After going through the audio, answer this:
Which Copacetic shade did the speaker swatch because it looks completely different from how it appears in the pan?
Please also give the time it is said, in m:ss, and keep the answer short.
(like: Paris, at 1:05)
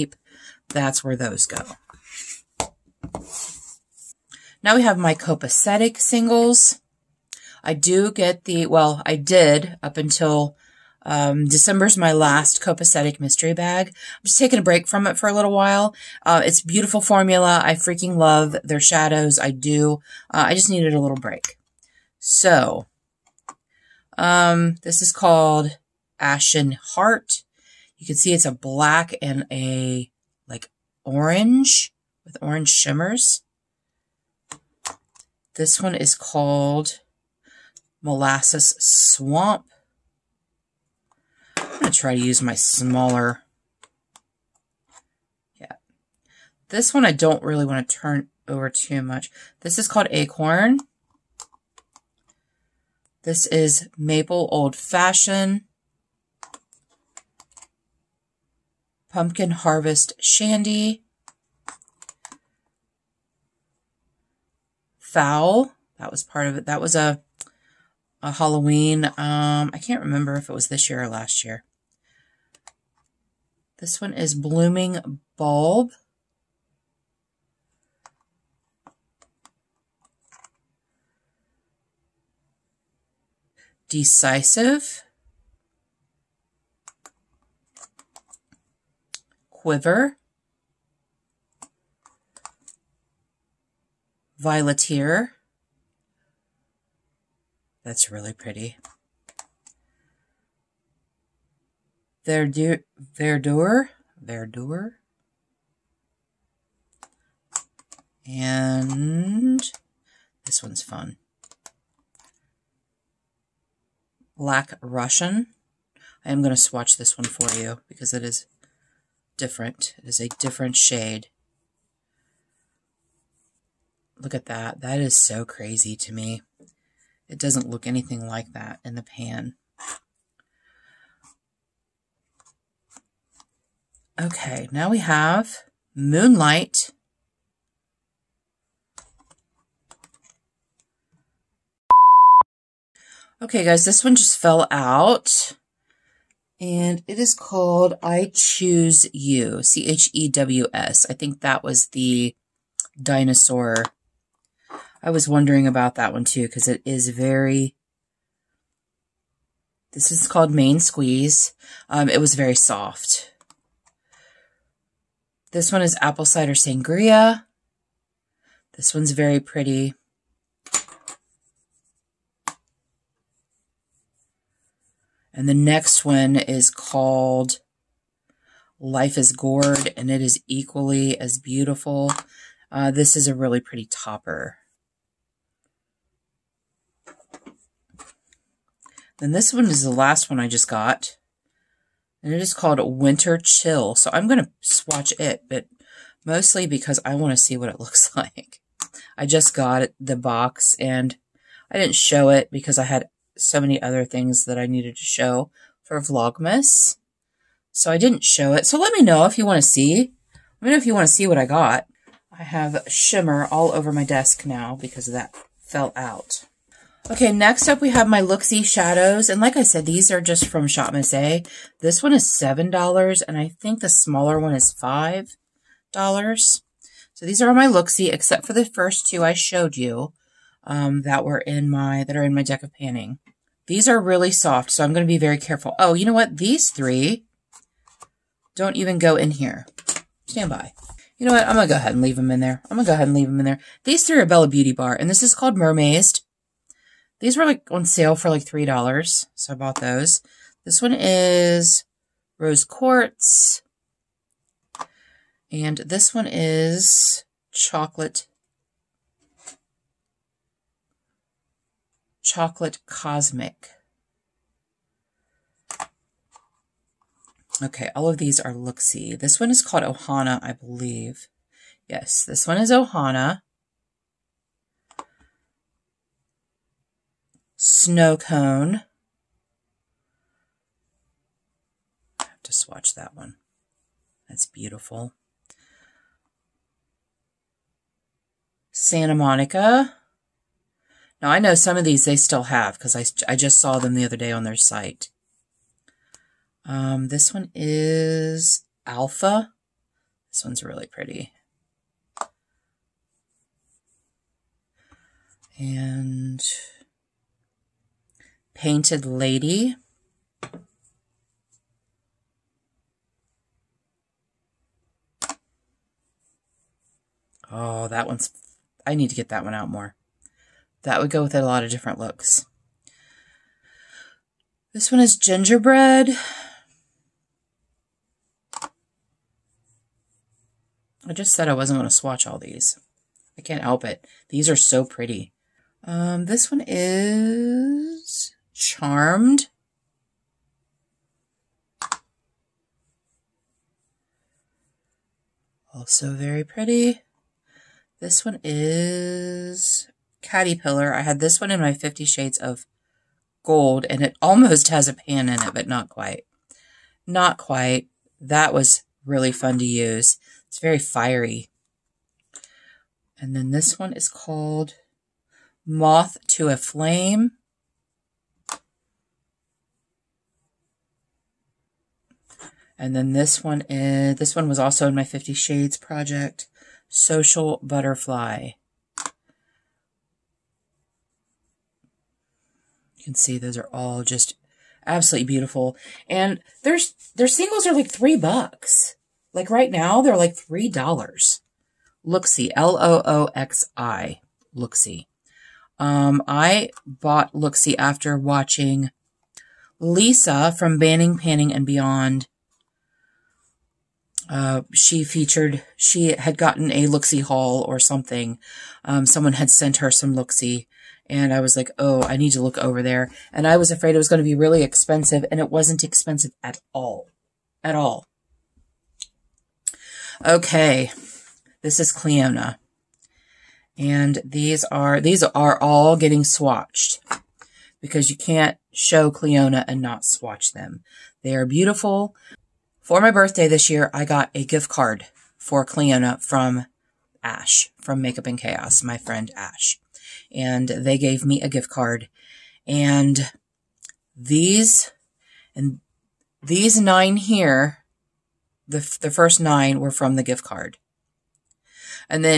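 Black Russian, at 1:54.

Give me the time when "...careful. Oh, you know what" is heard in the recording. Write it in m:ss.
3:55.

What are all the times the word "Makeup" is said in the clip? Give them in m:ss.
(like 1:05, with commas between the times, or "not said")
7:17.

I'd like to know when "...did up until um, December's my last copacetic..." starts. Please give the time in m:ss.
0:09.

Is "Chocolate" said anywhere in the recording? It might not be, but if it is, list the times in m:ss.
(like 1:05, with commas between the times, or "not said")
4:17, 4:22.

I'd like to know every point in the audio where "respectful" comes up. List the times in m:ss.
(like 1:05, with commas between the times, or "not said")
not said.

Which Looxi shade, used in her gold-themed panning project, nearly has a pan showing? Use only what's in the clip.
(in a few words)
Caterpillar.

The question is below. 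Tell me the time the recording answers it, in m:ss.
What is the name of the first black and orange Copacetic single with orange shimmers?
0:26.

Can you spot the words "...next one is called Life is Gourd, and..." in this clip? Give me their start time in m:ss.
2:55.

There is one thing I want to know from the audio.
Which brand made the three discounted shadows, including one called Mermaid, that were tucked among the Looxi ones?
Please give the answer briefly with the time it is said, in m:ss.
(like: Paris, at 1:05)
Bella Beauty Bar, at 4:04.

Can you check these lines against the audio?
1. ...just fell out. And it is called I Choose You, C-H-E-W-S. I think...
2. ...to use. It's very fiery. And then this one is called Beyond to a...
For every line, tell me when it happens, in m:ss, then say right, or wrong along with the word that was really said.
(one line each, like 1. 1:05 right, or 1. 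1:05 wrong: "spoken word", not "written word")
1. 2:24 right
2. 5:59 wrong: "Moth", not "Beyond".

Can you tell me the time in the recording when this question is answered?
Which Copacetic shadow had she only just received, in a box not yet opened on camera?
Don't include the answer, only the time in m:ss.
3:12.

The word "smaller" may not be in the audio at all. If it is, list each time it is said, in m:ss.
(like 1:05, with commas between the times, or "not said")
0:42, 3:43.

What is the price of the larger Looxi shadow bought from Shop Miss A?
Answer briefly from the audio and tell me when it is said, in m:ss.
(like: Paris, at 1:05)
$7, at 3:42.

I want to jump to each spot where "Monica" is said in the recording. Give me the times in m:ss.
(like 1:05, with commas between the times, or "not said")
4:49.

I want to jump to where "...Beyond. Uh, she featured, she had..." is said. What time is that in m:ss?
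6:41.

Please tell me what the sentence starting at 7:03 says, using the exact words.
And these are, these are all getting swatched because you can't show Clionadh and not swatch them.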